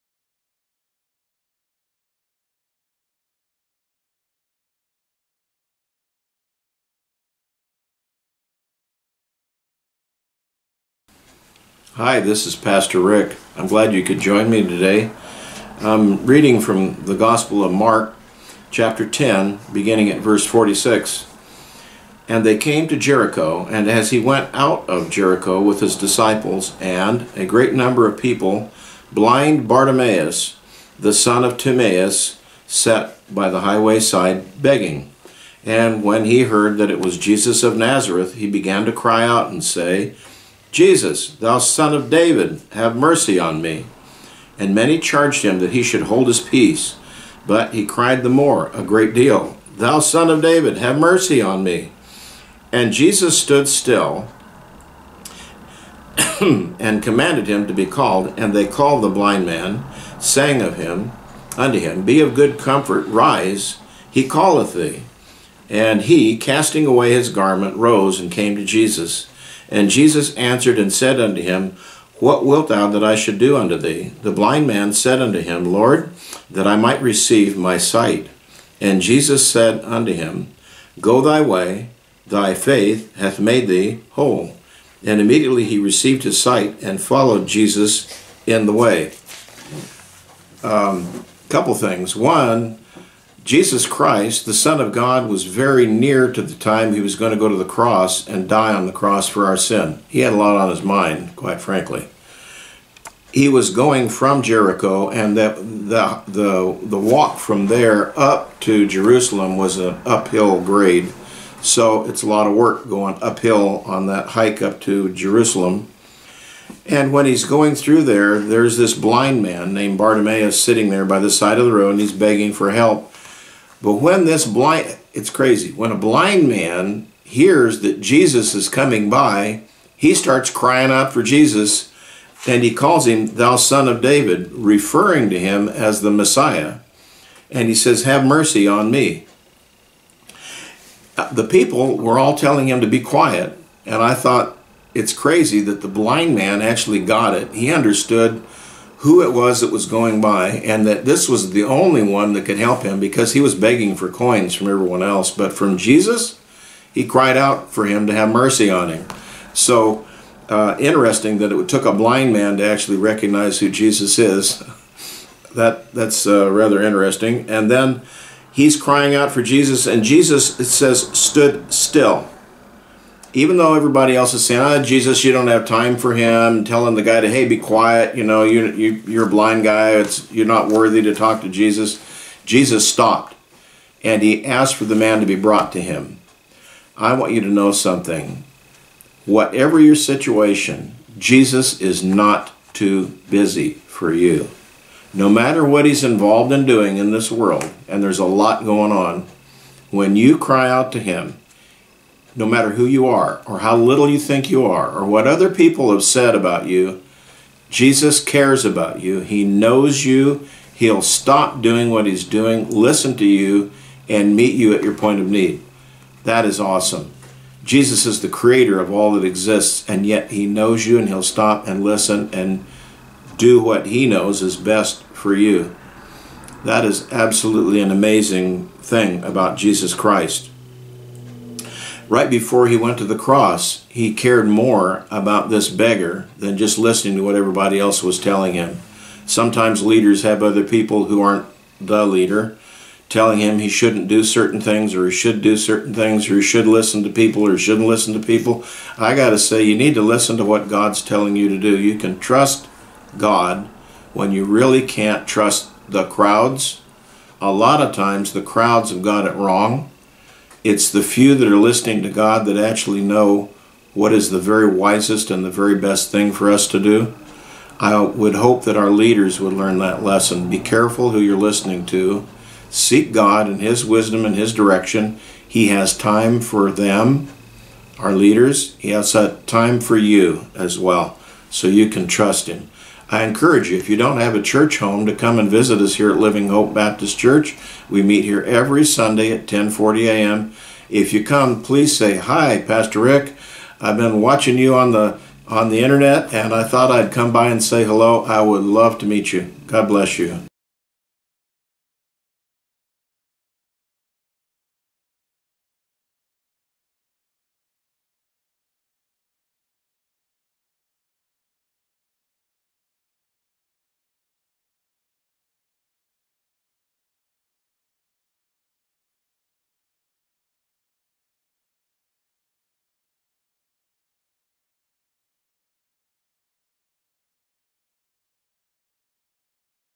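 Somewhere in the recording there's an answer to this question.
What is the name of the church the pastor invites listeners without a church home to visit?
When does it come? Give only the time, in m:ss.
4:46.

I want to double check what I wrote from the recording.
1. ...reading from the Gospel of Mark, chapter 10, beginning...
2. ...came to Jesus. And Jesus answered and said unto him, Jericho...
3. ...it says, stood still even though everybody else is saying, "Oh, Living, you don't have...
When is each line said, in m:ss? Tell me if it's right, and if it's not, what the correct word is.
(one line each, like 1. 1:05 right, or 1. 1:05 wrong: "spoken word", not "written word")
1. 0:16 right
2. 1:08 wrong: "What", not "Jericho"
3. 2:50 wrong: "Jesus", not "Living".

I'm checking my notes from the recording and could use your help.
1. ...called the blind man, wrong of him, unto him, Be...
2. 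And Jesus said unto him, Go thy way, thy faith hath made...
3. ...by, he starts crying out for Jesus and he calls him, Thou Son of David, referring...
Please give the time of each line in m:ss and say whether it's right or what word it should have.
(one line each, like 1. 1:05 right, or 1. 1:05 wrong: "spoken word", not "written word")
1. 0:58 wrong: "saying", not "wrong"
2. 1:18 right
3. 2:09 right.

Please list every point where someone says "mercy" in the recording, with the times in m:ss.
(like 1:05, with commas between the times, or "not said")
0:42, 0:50, 2:18, 2:38.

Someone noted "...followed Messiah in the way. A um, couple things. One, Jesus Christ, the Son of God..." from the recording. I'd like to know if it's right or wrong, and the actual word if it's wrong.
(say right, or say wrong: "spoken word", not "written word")
wrong: "Jesus", not "Messiah".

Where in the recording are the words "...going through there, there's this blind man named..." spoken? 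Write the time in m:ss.
1:57.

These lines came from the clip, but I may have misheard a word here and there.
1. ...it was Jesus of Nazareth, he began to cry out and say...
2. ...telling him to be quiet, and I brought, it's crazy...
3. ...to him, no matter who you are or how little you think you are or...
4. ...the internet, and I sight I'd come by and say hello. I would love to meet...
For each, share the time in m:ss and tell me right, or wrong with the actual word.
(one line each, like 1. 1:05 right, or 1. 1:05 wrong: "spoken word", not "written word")
1. 0:36 right
2. 2:22 wrong: "thought", not "brought"
3. 3:20 right
4. 4:55 wrong: "thought", not "sight".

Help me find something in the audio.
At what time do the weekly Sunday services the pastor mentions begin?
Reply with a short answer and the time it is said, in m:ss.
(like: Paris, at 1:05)
10:40 a.m., at 4:49.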